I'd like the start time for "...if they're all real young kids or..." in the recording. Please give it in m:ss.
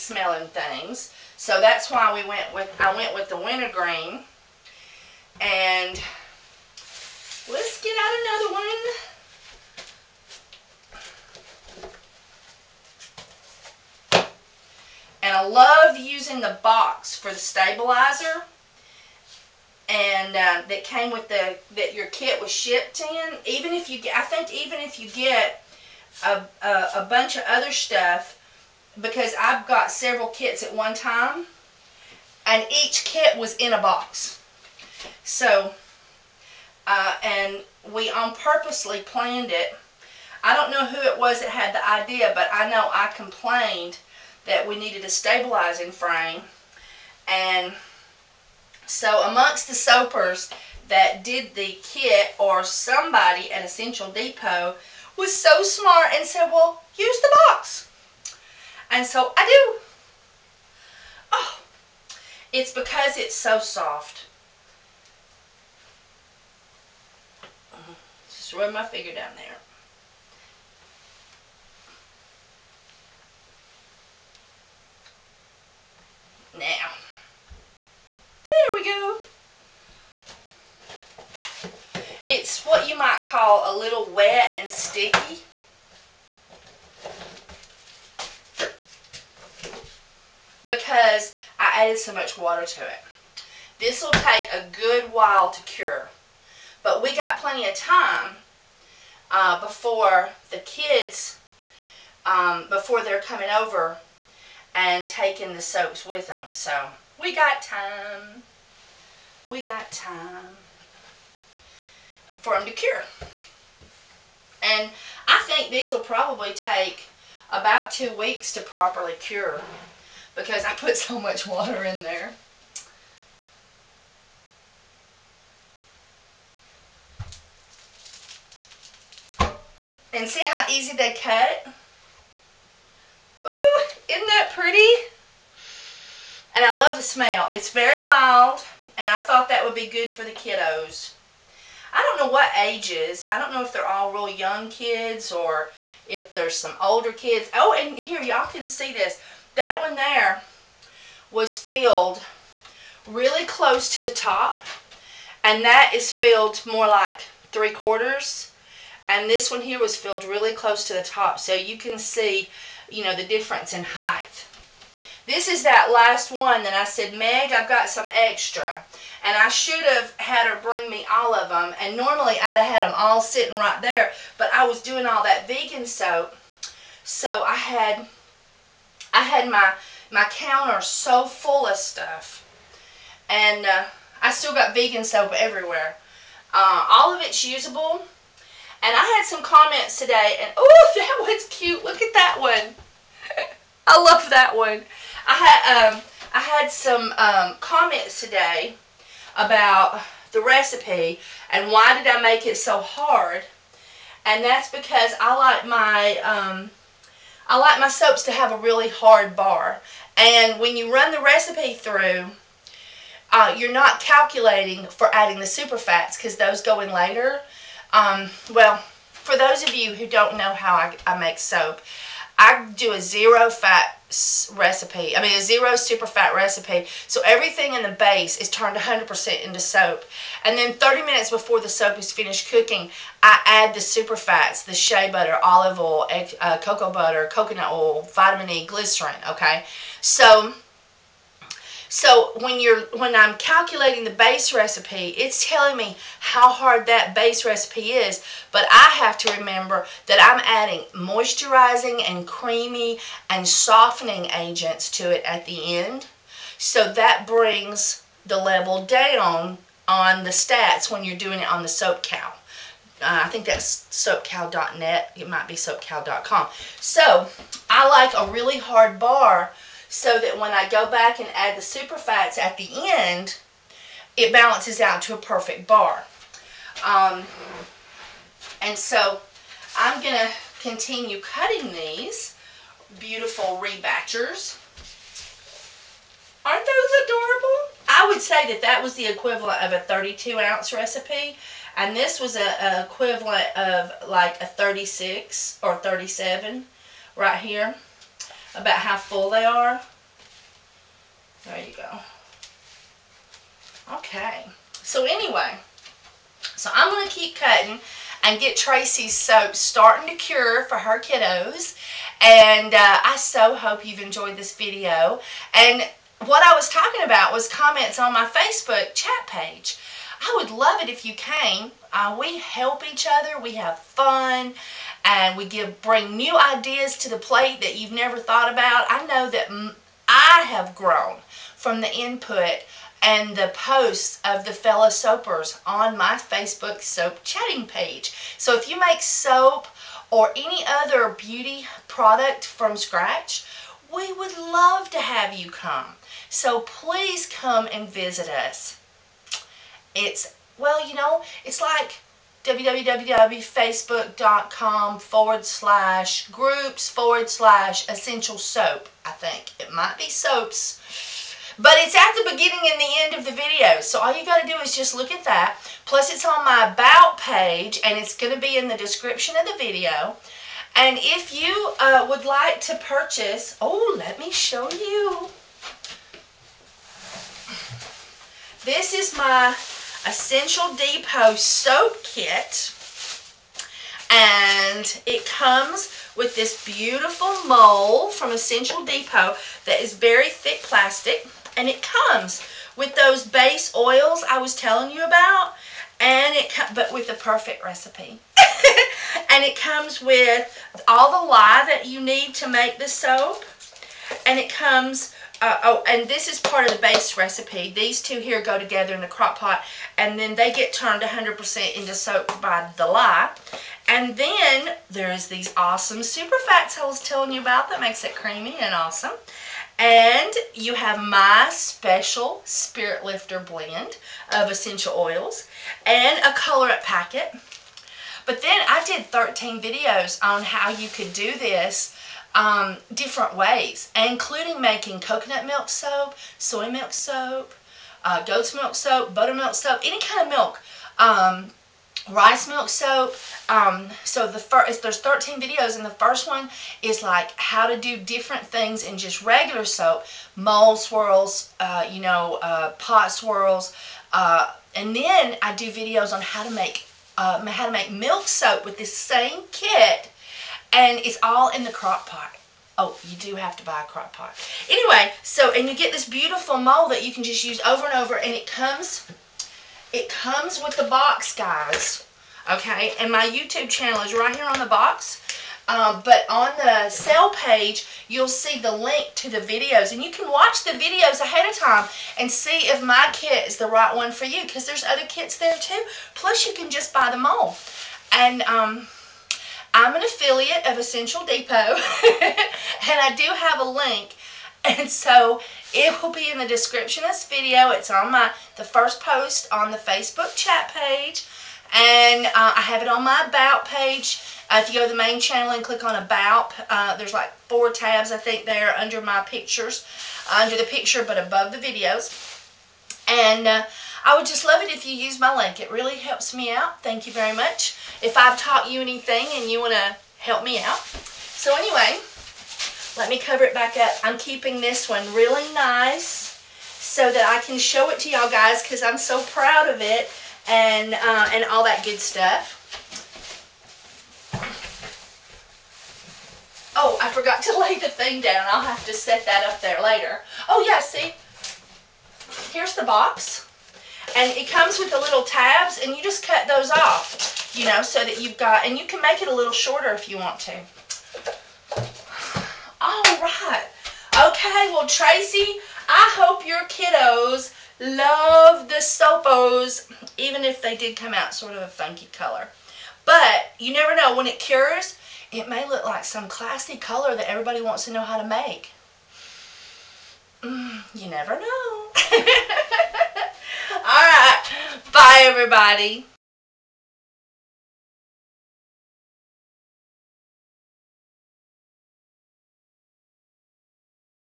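2:23.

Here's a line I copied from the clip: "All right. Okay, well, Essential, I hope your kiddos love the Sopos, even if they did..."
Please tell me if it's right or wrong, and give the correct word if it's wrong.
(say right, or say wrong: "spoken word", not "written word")
wrong: "Tracy", not "Essential".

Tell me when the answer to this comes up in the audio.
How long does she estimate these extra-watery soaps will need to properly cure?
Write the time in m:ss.
1:57.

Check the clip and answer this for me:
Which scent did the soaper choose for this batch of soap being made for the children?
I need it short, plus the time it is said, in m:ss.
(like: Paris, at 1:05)
wintergreen, at 0:03.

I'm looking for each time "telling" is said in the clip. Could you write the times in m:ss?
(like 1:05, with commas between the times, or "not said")
4:05, 6:34, 6:56.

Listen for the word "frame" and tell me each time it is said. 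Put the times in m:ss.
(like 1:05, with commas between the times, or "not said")
0:45.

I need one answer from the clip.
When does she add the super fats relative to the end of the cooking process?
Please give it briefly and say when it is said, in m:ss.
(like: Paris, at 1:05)
30 minutes before, at 3:50.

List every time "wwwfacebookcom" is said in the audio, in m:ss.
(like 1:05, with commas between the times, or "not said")
5:52.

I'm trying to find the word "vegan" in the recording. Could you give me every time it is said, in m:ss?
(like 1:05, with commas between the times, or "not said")
2:55, 3:04.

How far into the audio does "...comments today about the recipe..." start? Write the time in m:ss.
3:17.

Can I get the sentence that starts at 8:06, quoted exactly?
Plus, you can just buy the mold.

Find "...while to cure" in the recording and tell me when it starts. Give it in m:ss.
1:35.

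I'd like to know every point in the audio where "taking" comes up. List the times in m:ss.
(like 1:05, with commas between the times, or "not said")
1:45.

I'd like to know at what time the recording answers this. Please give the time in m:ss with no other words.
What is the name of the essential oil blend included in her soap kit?
7:02.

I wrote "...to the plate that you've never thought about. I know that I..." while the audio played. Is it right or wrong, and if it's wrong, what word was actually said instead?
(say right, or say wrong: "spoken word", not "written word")
right.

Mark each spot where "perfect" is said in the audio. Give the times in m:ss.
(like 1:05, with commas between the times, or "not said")
4:35, 6:37.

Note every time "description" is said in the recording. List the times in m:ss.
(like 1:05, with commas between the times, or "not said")
6:08, 8:16.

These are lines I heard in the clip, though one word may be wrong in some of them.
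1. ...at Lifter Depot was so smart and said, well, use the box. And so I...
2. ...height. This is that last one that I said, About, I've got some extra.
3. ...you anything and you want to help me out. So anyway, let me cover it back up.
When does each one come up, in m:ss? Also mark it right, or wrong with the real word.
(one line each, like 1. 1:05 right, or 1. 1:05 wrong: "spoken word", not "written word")
1. 0:53 wrong: "Essential", not "Lifter"
2. 2:43 wrong: "Meg", not "About"
3. 8:38 right.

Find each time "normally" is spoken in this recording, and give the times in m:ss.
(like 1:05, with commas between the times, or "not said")
2:51.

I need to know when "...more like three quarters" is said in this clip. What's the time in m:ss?
2:36.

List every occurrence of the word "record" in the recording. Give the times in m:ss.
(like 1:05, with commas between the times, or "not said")
not said.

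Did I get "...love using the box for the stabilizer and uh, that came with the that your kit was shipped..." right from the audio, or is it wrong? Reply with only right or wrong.
right.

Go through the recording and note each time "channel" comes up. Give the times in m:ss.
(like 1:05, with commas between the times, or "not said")
7:53, 8:25.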